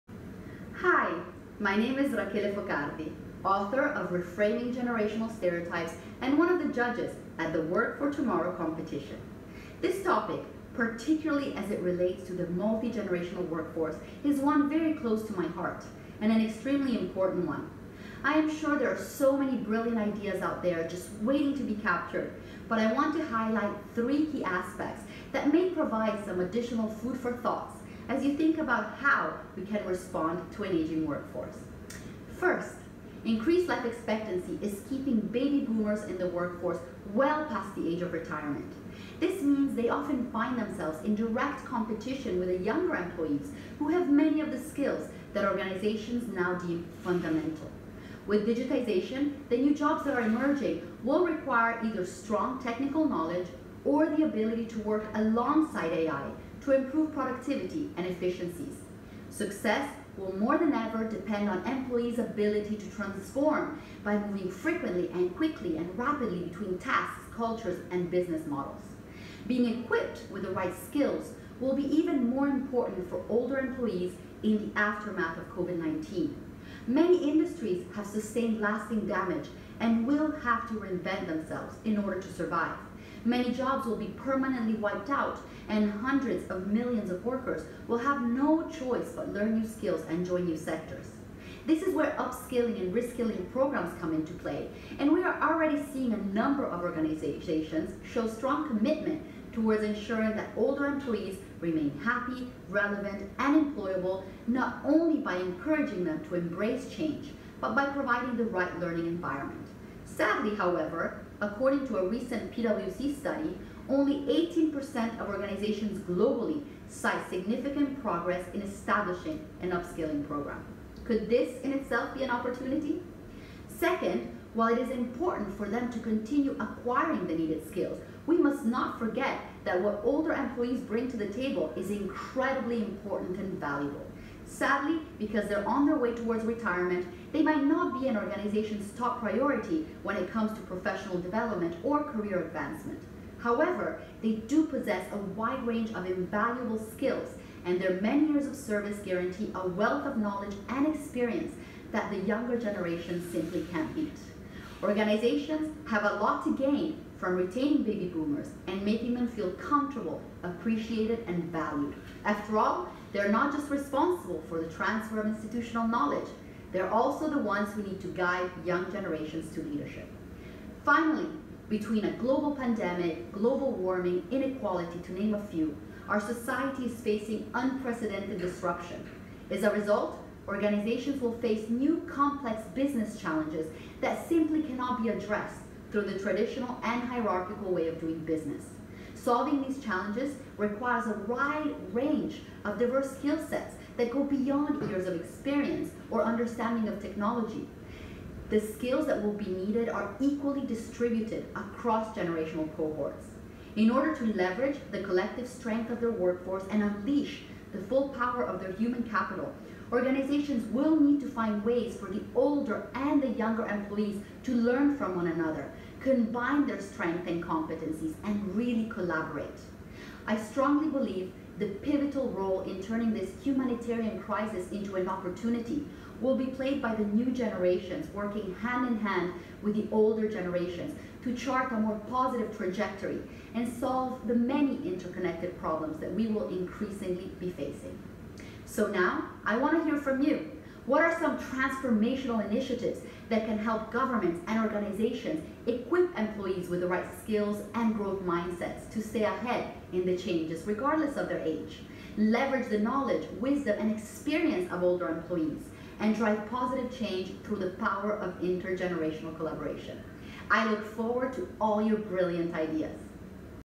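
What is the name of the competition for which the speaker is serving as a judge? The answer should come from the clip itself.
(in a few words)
Work for Tomorrow.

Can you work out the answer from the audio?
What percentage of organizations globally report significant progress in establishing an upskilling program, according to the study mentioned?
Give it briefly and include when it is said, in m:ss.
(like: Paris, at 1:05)
18%, at 1:54.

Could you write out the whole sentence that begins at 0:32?
First, increased life expectancy is keeping baby boomers in the workforce well past the age of retirement.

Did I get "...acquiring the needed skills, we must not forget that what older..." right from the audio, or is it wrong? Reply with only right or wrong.
right.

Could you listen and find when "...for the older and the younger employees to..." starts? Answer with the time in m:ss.
3:31.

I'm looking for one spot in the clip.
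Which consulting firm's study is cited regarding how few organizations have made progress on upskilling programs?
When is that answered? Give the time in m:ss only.
1:52.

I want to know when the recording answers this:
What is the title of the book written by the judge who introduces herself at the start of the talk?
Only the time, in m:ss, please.
0:04.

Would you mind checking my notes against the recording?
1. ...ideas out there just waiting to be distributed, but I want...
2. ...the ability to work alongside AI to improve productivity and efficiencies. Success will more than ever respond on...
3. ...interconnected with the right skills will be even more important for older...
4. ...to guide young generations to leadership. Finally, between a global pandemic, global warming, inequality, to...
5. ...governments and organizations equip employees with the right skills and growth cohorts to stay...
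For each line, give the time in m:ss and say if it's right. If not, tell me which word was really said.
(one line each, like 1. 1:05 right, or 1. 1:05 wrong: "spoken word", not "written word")
1. 0:19 wrong: "captured", not "distributed"
2. 0:54 wrong: "depend", not "respond"
3. 1:09 wrong: "equipped", not "interconnected"
4. 2:48 right
5. 4:03 wrong: "mindsets", not "cohorts".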